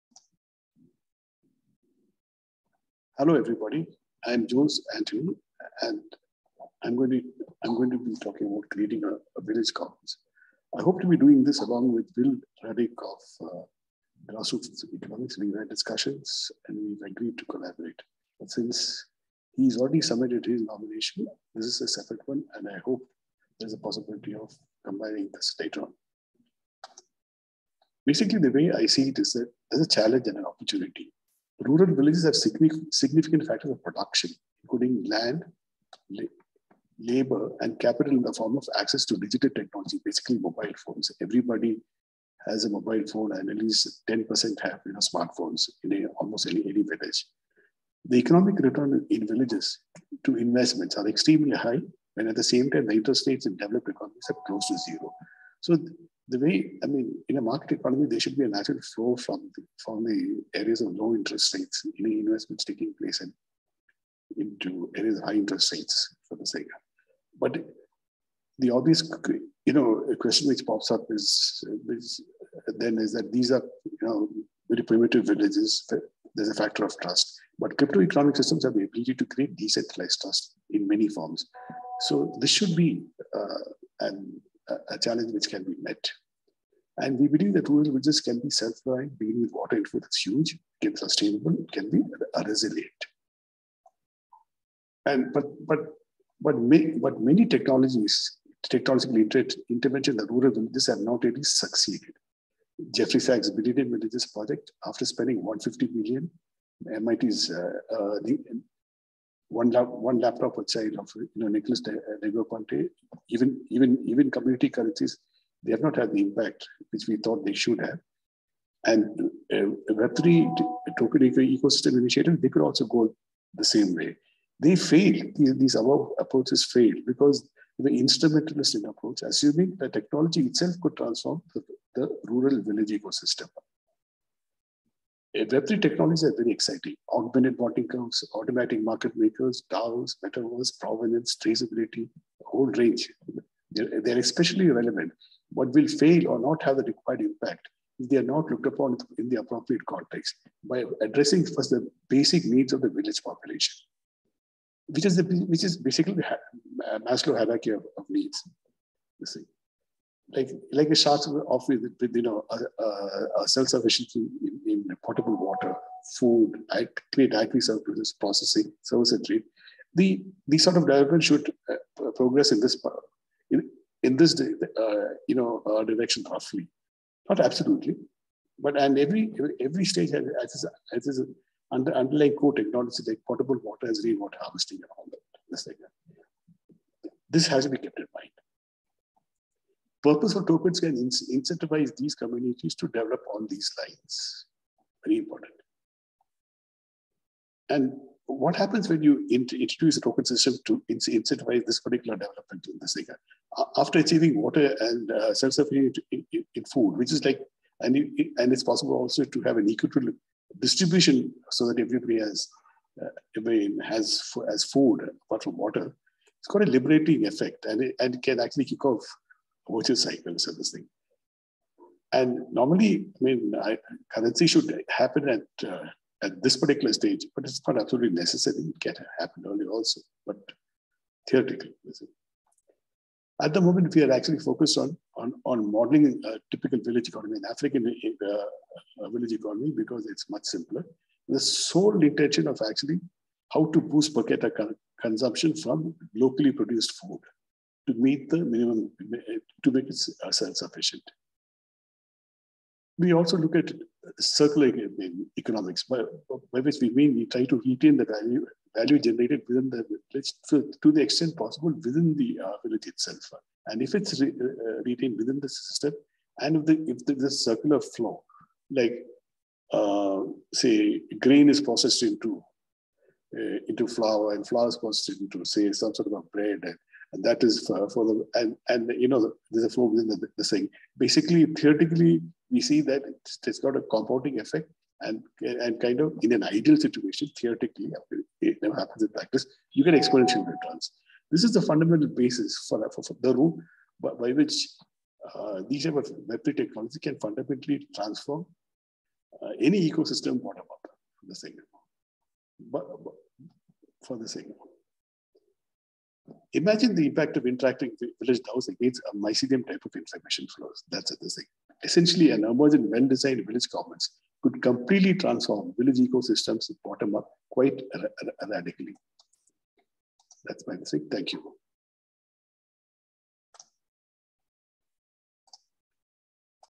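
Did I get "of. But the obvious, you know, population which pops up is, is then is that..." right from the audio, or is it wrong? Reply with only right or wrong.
wrong.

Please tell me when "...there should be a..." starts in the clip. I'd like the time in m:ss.
0:58.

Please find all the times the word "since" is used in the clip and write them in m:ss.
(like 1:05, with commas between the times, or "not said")
0:18.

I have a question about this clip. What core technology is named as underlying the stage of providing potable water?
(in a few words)
Rainwater harvesting.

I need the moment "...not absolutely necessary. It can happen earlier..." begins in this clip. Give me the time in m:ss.
3:47.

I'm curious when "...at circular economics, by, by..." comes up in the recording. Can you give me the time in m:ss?
4:13.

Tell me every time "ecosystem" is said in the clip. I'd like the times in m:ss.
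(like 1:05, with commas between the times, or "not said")
2:01, 2:12, 4:59, 5:15.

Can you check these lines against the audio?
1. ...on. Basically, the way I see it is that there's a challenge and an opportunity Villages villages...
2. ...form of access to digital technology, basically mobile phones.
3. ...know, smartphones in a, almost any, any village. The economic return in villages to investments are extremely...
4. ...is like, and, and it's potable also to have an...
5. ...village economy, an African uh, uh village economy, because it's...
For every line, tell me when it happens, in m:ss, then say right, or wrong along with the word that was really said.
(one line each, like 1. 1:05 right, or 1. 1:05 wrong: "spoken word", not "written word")
1. 0:25 wrong: "Rural", not "Villages"
2. 0:38 right
3. 0:44 right
4. 3:27 wrong: "possible", not "potable"
5. 3:56 right.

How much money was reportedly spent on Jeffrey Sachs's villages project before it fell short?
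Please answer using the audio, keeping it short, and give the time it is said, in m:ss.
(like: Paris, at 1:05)
150 million, at 1:45.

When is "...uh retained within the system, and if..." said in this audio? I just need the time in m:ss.
4:24.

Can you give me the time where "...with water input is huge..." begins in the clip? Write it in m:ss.
1:29.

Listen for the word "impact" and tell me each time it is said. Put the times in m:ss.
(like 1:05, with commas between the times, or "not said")
1:56, 2:27, 5:07.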